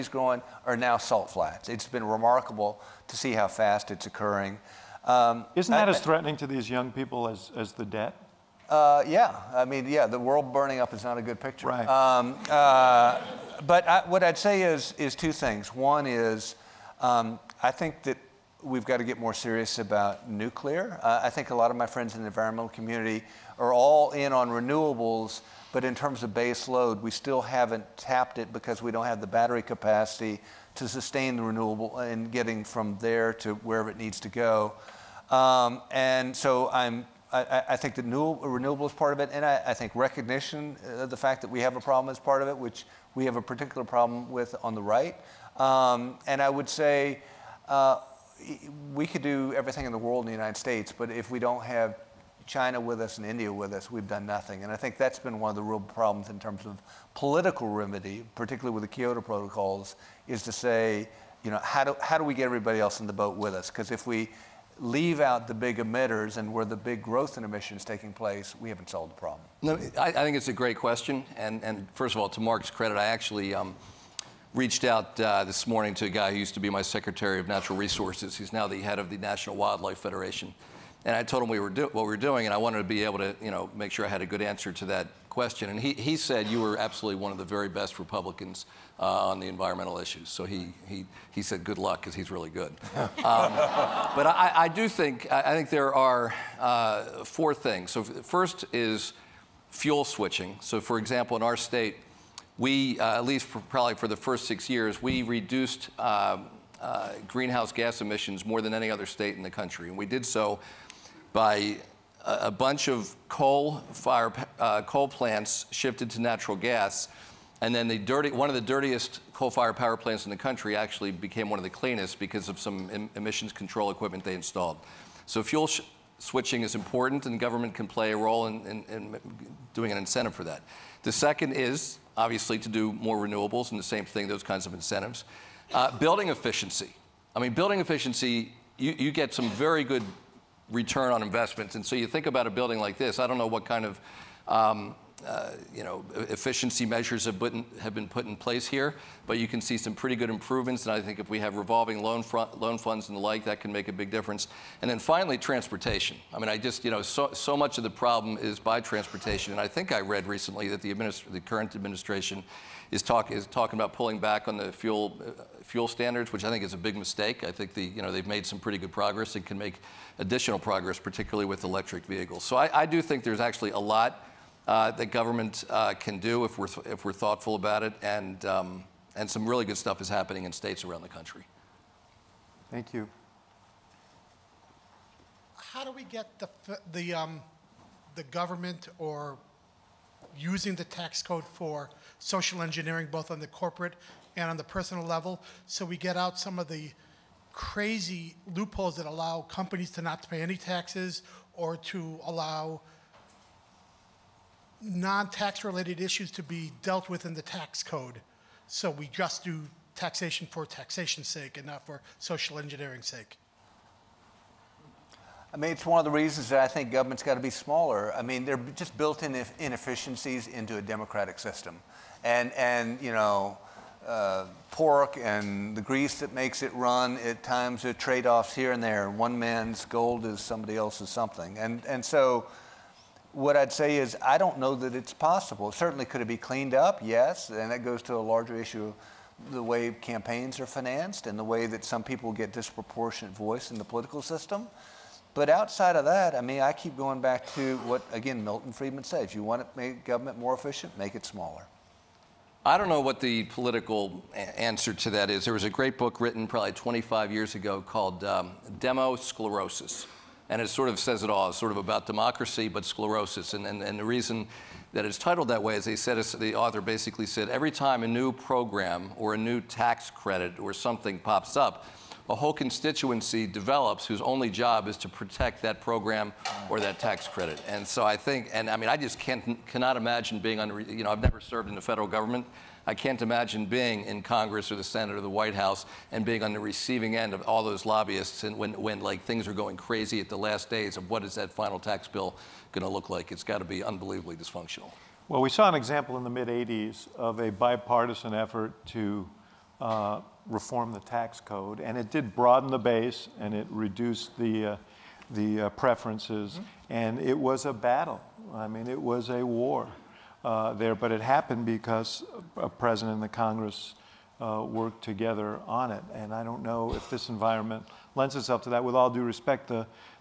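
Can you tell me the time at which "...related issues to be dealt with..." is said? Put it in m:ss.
3:25.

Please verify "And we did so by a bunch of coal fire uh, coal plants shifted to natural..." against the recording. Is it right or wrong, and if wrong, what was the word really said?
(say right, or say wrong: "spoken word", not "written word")
right.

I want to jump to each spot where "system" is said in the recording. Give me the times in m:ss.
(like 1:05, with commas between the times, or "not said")
3:41, 4:04.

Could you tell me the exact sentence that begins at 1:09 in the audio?
No, I, I think it's a great question.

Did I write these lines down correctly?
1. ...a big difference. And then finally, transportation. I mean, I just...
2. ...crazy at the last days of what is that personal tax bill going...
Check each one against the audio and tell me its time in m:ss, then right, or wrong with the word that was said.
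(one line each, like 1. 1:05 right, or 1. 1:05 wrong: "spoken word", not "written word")
1. 2:33 right
2. 4:49 wrong: "final", not "personal".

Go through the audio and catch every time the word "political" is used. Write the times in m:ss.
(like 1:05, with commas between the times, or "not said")
0:57, 4:03, 4:13.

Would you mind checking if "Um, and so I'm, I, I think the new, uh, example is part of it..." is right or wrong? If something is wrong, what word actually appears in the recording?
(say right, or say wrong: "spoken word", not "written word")
wrong: "renewable", not "example".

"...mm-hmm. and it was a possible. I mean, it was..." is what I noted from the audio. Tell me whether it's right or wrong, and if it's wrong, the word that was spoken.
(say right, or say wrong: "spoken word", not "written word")
wrong: "battle", not "possible".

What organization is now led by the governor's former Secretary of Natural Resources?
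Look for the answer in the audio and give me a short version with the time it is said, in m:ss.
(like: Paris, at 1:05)
National Wildlife Federation, at 1:19.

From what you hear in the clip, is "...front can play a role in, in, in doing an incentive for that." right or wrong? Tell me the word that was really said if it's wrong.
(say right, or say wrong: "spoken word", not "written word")
wrong: "government", not "front".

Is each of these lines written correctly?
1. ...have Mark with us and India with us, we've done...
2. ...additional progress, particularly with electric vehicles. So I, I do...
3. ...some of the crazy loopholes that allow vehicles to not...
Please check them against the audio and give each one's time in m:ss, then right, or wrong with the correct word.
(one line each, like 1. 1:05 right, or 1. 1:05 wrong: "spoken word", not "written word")
1. 0:51 wrong: "China", not "Mark"
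2. 2:50 right
3. 3:16 wrong: "companies", not "vehicles".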